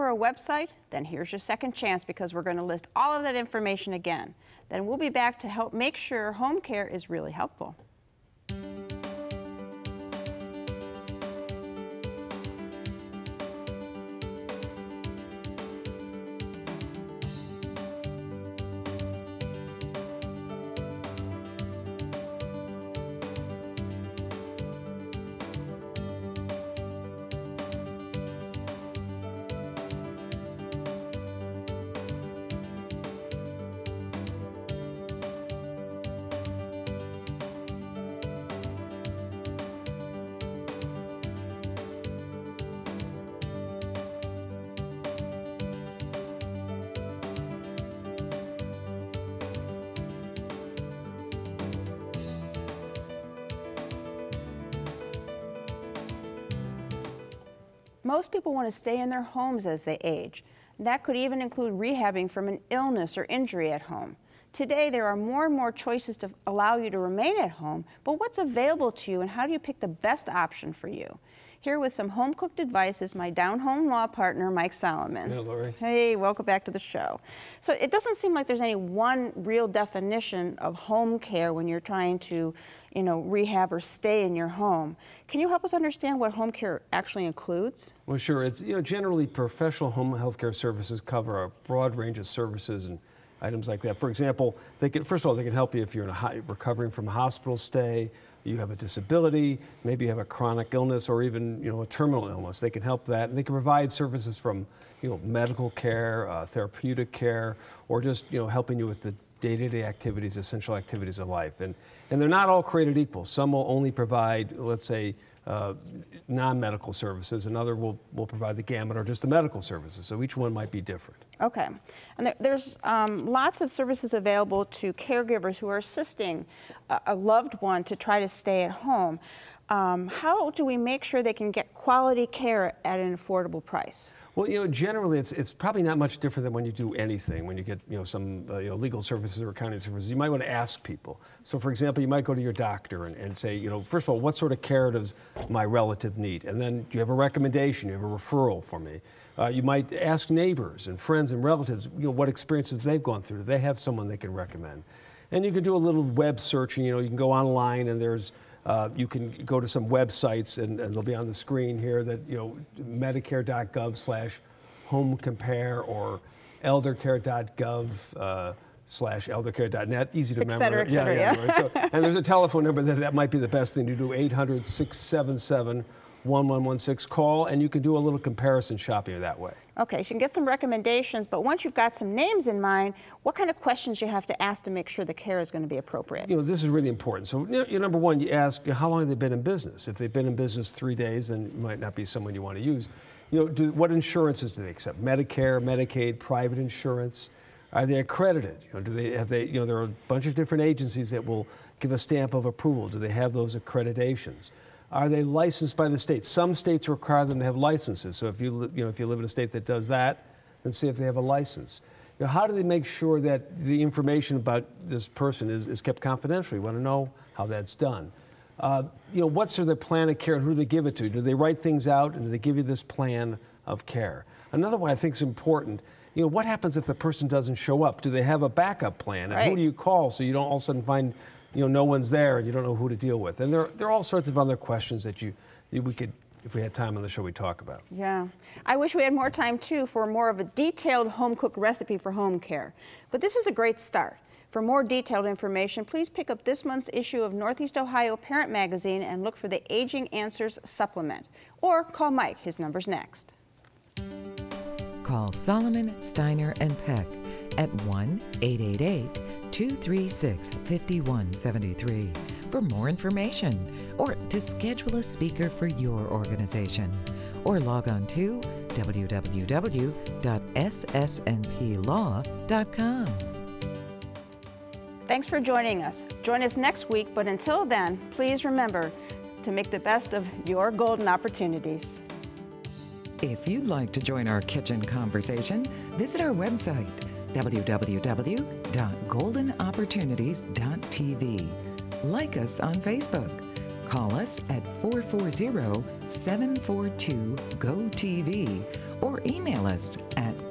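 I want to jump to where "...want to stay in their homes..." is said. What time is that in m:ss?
0:58.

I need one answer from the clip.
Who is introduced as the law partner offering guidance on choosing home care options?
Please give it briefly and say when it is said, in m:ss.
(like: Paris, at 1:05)
Mike Solomon, at 1:14.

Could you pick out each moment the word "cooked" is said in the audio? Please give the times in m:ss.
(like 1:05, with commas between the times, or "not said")
1:12, 4:01.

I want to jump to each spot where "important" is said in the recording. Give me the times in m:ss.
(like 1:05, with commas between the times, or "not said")
3:06, 3:45.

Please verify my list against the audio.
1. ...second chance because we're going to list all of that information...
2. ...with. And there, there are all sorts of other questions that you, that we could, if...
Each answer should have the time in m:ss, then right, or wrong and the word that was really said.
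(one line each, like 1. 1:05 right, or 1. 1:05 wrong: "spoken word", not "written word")
1. 0:01 right
2. 3:53 right.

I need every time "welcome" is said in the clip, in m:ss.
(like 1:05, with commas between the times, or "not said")
1:16.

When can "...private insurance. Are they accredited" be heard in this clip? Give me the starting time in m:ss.
3:16.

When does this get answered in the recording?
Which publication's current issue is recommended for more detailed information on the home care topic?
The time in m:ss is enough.
4:07.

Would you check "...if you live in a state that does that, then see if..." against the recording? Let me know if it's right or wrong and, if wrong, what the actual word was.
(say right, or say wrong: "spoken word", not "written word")
right.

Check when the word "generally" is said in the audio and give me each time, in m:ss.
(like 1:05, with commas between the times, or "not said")
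1:28, 2:14.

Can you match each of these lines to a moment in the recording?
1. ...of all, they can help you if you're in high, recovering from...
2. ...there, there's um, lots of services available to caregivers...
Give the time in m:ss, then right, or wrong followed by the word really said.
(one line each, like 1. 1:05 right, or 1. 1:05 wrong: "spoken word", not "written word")
1. 1:35 right
2. 2:02 right.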